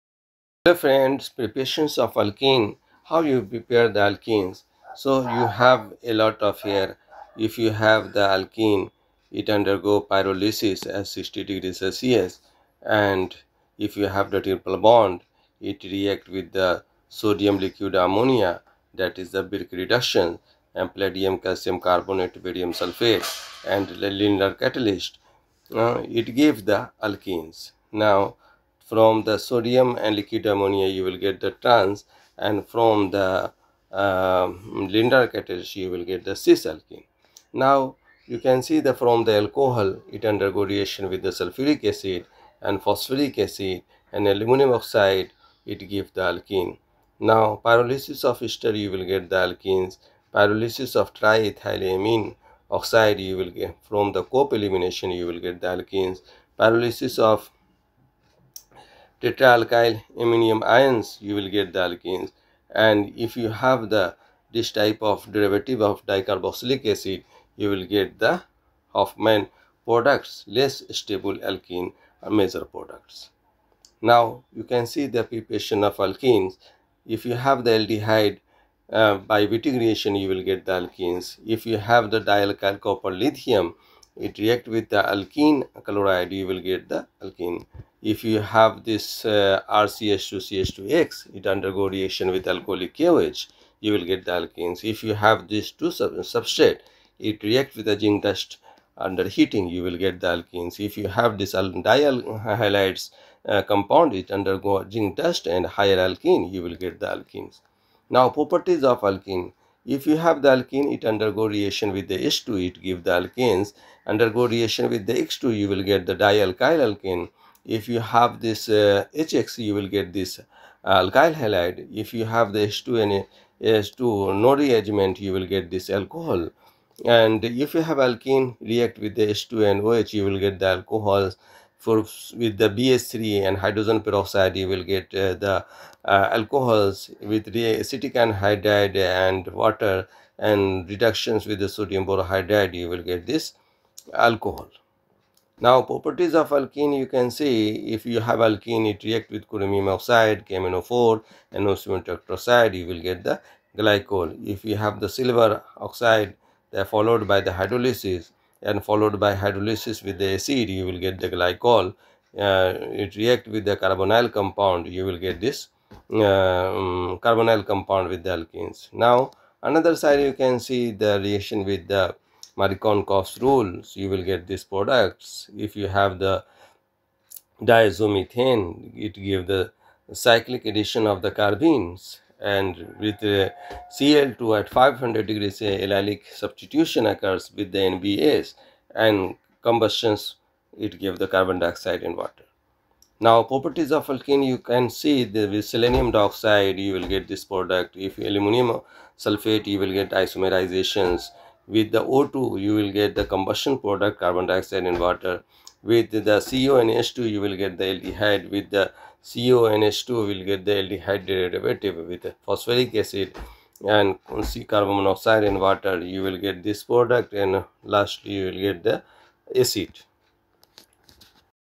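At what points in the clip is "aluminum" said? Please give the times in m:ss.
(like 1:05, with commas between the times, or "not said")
0:44, 3:18.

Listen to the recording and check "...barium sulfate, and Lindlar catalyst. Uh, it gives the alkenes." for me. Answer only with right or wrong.
right.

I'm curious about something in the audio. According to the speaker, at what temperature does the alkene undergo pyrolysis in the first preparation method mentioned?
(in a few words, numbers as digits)
60 degrees Celsius.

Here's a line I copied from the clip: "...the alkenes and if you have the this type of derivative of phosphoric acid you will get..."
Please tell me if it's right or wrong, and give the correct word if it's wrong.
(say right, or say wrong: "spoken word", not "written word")
wrong: "dicarboxylic", not "phosphoric".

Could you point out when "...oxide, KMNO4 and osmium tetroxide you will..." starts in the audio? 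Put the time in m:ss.
2:29.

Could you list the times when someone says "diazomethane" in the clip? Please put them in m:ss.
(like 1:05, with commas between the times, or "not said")
2:57.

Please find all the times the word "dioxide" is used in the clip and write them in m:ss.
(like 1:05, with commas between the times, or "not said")
3:11, 3:16, 3:24.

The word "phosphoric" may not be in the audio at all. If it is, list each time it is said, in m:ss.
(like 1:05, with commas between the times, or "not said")
0:42, 3:32.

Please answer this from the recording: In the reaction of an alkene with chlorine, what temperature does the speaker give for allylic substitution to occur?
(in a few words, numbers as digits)
500 degrees.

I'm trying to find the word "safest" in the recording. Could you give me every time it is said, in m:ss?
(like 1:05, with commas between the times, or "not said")
not said.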